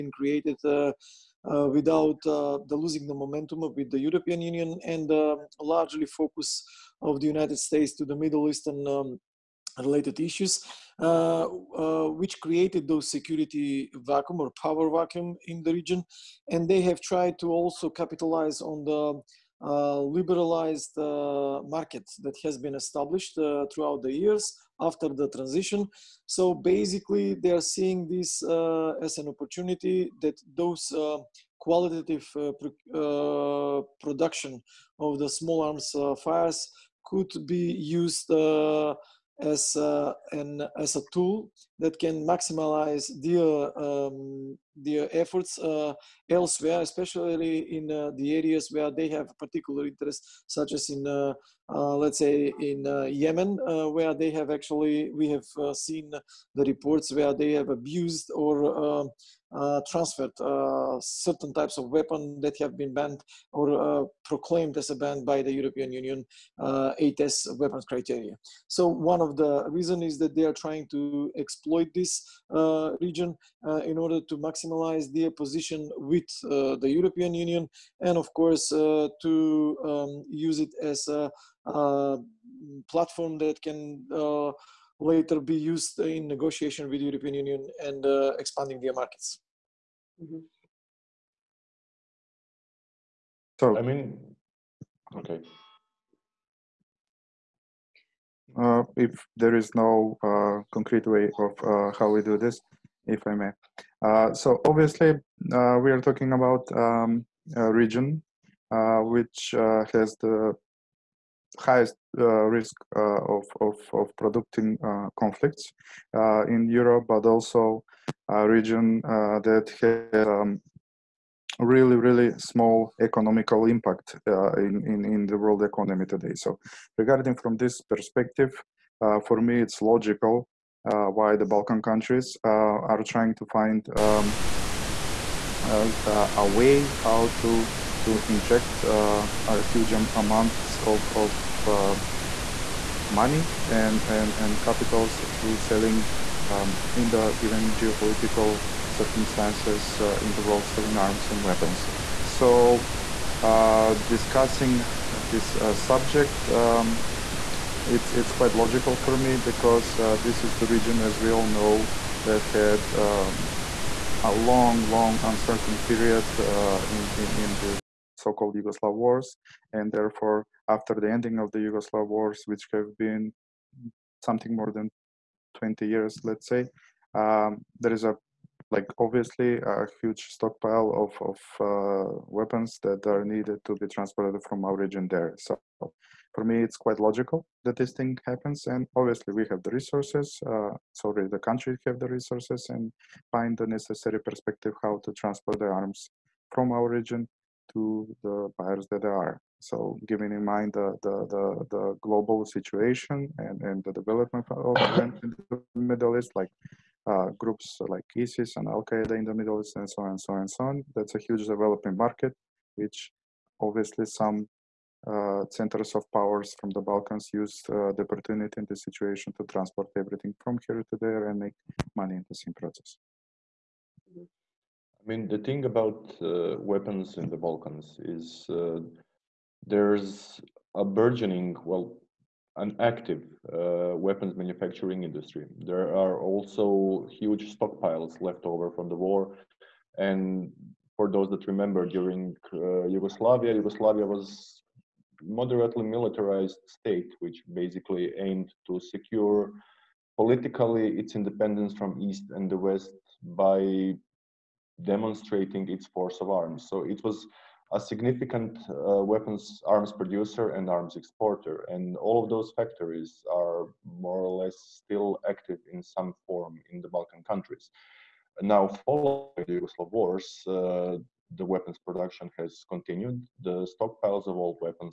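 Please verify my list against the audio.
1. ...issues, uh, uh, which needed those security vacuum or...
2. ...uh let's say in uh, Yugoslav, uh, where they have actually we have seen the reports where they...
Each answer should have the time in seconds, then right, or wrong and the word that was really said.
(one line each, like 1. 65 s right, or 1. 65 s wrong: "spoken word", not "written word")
1. 10 s wrong: "created", not "needed"
2. 51 s wrong: "Yemen", not "Yugoslav".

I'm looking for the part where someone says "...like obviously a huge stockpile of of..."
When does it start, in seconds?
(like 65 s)
178 s.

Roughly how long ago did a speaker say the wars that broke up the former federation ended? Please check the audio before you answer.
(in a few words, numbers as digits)
more than 20 years.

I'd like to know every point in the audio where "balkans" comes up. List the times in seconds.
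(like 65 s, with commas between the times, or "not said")
131 s, 216 s, 227 s, 266 s.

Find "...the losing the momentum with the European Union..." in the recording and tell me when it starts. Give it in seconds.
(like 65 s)
2 s.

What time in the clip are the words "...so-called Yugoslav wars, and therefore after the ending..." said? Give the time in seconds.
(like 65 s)
168 s.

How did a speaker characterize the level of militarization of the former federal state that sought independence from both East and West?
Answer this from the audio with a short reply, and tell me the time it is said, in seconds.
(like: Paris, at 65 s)
moderately militarized, at 245 s.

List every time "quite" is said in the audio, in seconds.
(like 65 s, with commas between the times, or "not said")
158 s, 186 s.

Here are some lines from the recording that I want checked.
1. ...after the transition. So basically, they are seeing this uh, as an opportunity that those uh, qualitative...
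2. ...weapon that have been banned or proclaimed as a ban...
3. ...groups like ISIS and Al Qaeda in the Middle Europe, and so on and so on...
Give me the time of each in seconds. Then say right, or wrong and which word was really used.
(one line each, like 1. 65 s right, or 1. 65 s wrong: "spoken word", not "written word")
1. 24 s right
2. 61 s right
3. 207 s wrong: "East", not "Europe".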